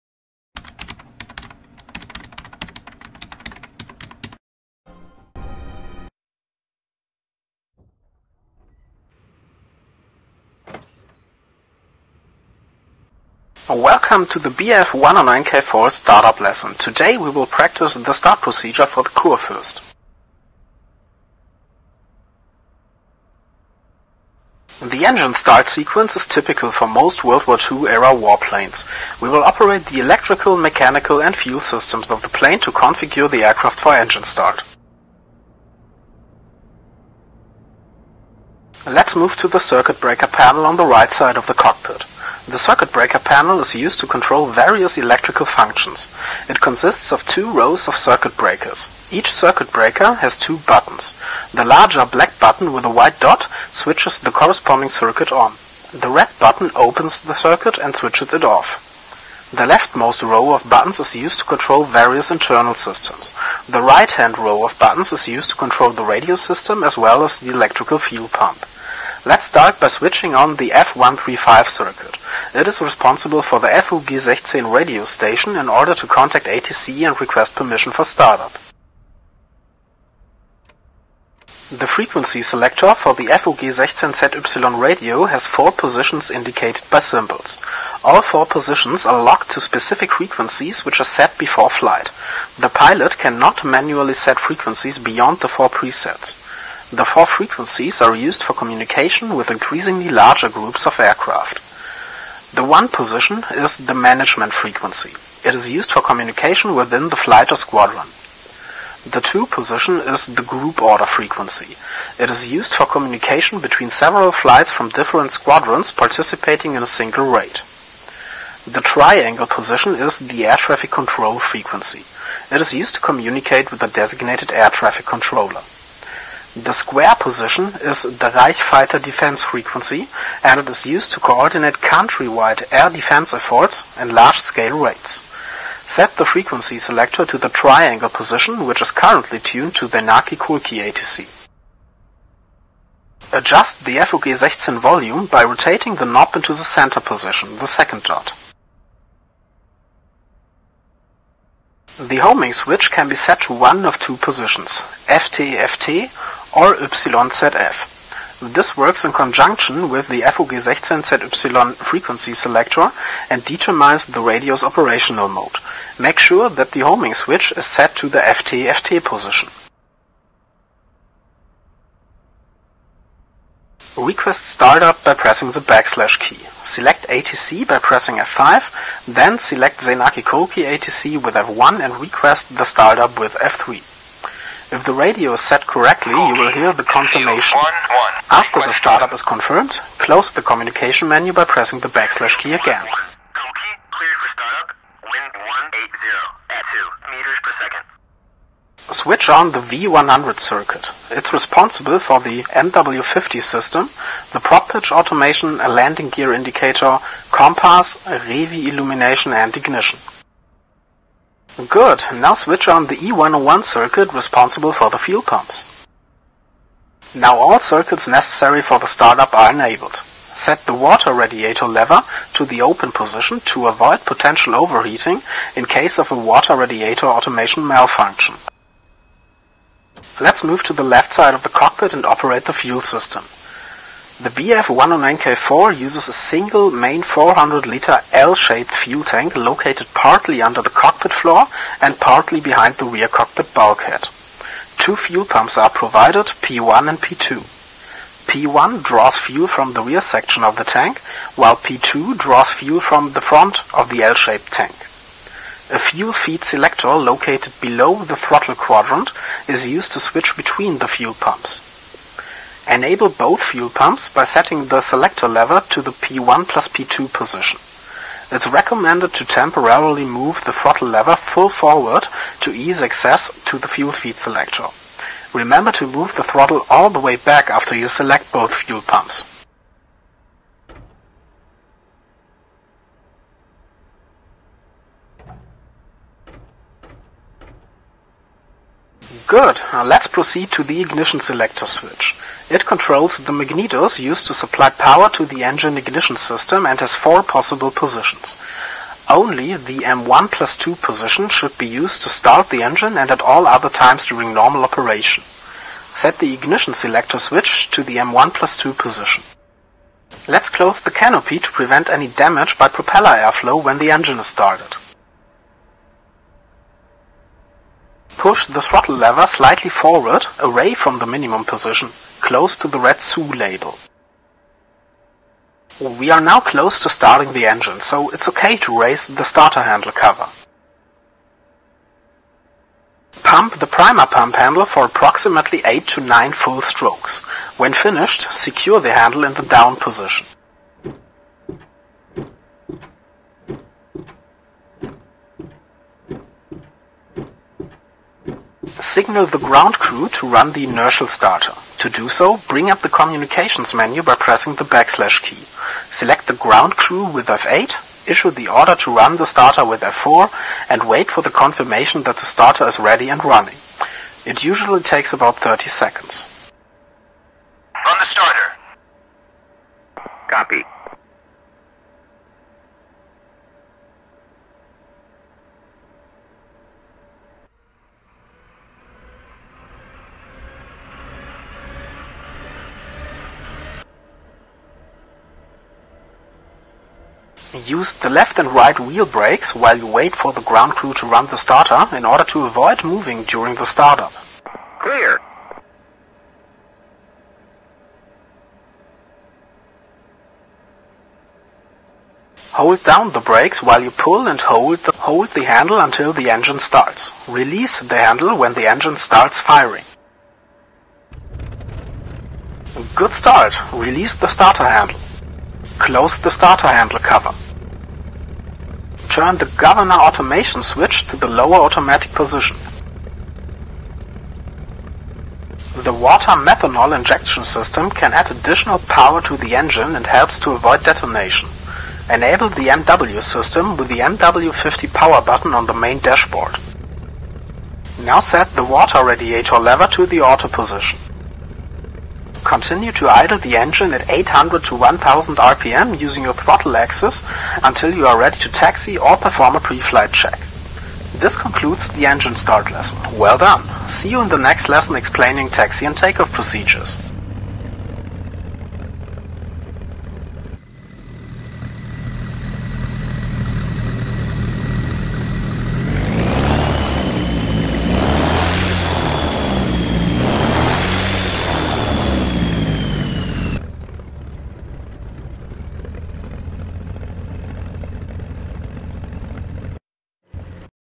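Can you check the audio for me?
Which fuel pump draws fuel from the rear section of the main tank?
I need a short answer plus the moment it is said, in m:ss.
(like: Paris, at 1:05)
P1, at 4:08.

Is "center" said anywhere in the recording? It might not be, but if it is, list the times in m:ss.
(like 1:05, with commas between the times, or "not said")
2:26.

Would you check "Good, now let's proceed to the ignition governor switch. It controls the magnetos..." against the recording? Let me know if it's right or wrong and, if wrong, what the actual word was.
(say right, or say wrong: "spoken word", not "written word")
wrong: "selector", not "governor".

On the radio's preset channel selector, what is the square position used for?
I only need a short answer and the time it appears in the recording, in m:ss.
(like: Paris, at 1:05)
Reich fighter defense, at 2:08.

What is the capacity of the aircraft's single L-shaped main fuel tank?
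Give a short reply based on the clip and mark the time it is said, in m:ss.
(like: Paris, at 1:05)
400 liters, at 3:57.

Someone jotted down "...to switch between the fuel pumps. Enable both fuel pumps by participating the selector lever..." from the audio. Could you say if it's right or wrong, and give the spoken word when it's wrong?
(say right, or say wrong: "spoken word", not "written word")
wrong: "setting", not "participating".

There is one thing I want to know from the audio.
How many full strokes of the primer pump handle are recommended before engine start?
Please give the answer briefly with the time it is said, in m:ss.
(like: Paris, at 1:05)
8 to 9, at 5:35.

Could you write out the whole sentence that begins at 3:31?
Good, now switch on the E101 circuit responsible for the fuel pumps.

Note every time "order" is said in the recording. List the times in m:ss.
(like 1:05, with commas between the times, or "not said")
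1:15, 1:50, 5:58, 6:32.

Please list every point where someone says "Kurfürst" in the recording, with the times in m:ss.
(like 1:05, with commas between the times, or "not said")
0:19.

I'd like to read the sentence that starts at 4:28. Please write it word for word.
It's recommended to temporarily move the throttle lever full forward to ease access to the fuel feed selector.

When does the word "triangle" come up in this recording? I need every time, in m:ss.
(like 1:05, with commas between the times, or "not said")
1:58, 2:17.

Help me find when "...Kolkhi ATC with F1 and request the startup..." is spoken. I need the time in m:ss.
3:00.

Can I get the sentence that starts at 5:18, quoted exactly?
Push the throttle lever slightly forward, away from the minimum position close to the red SU label.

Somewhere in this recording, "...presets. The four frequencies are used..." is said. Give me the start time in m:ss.
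1:35.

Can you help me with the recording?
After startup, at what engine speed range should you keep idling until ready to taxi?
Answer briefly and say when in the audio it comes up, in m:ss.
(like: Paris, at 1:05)
800 to 1000 RPM, at 7:24.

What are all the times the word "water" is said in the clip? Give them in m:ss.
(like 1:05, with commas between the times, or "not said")
3:40, 3:46, 7:05, 7:18.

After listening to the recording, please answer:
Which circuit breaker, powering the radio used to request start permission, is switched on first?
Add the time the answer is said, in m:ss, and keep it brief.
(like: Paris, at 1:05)
F135, at 1:10.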